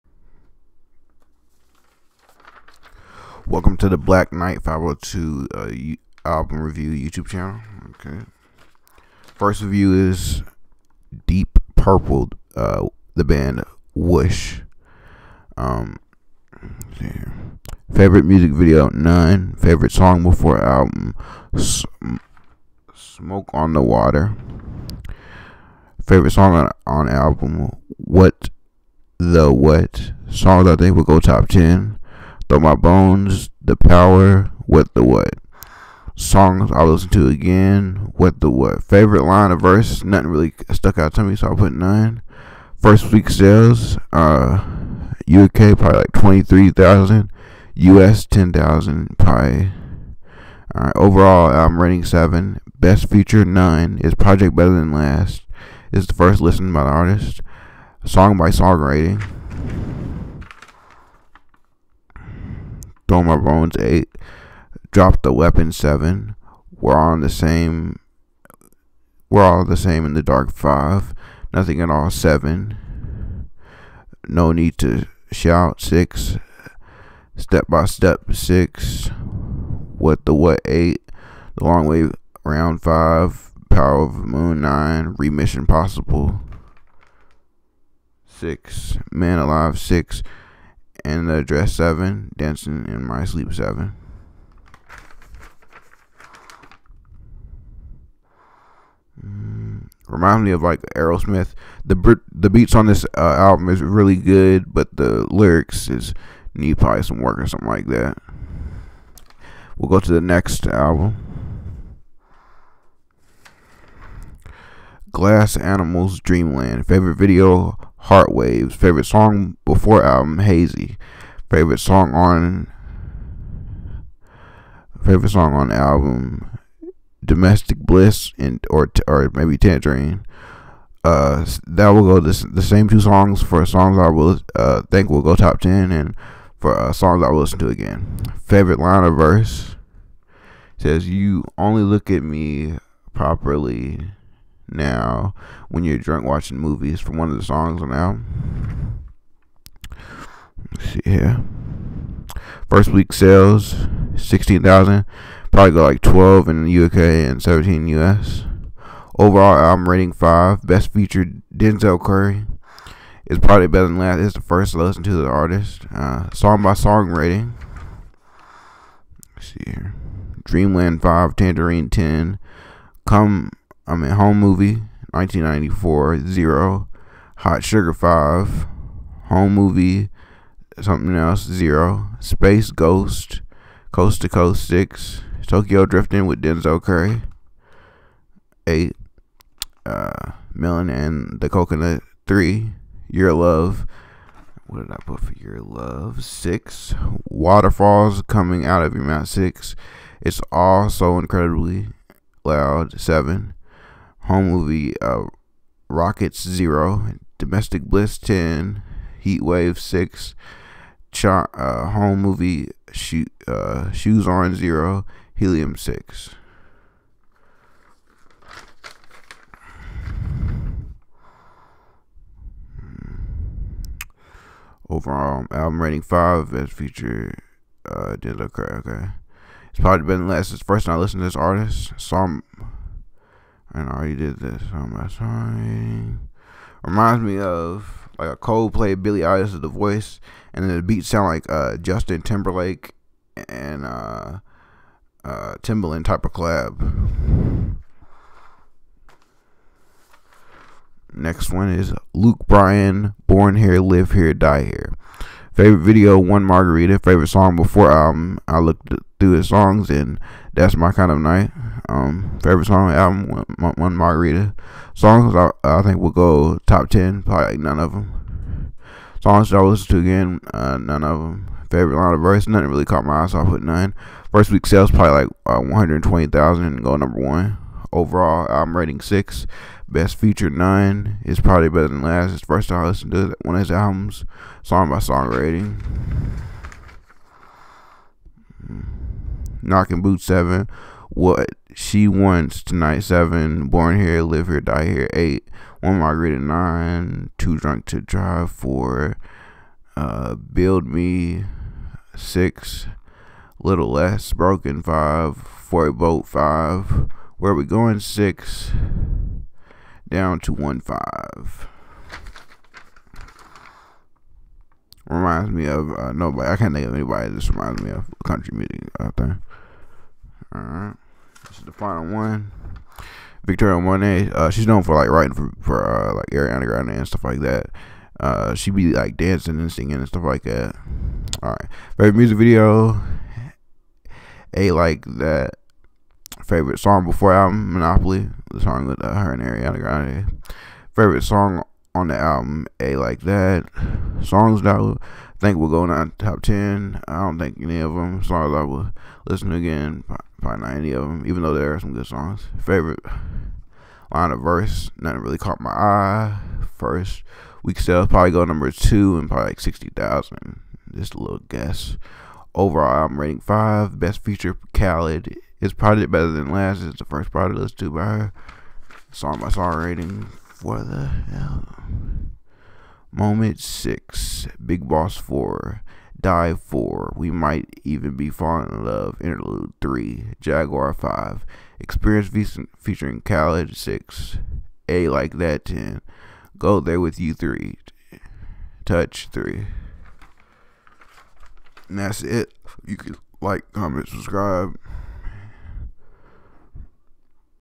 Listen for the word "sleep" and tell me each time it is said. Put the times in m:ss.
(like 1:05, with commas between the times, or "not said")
1:33.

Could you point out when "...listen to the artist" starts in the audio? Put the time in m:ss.
2:44.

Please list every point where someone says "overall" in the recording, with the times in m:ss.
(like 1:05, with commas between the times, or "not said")
0:50, 2:39, 3:44, 4:37, 6:02.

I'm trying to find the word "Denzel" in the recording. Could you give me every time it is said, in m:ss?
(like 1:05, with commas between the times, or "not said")
2:41, 3:06, 3:48.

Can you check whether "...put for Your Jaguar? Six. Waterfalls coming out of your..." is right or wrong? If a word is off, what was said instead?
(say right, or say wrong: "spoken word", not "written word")
wrong: "Love", not "Jaguar".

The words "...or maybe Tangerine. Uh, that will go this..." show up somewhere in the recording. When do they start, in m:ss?
2:09.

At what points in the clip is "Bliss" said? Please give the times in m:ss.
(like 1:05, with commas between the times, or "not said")
2:07, 3:27.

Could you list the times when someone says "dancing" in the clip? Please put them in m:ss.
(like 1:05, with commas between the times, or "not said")
1:32, 5:29.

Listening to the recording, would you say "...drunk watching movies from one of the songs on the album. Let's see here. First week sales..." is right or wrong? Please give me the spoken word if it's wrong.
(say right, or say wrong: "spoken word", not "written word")
right.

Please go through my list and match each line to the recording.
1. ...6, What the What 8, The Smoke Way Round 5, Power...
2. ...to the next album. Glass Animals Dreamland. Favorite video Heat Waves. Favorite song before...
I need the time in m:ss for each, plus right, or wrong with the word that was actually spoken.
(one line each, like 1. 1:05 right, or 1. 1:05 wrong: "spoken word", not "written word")
1. 1:18 wrong: "Long", not "Smoke"
2. 1:49 right.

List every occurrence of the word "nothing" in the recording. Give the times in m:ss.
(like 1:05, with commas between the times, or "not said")
0:40, 1:11, 4:32, 5:54.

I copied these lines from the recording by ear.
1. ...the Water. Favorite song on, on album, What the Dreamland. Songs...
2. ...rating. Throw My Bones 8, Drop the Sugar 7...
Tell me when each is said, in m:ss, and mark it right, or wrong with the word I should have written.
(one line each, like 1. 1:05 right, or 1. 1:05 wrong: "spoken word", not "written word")
1. 0:23 wrong: "What", not "Dreamland"
2. 0:58 wrong: "Weapon", not "Sugar".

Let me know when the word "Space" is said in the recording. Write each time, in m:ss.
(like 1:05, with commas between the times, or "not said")
3:02.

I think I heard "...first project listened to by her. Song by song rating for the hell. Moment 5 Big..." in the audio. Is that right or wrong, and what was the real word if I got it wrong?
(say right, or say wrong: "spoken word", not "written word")
wrong: "6", not "5".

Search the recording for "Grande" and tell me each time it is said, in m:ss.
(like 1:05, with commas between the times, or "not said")
5:26, 5:39.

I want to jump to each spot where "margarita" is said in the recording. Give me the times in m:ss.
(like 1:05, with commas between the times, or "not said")
4:16, 4:23, 4:55.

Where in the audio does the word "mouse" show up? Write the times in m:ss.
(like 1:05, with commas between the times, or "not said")
not said.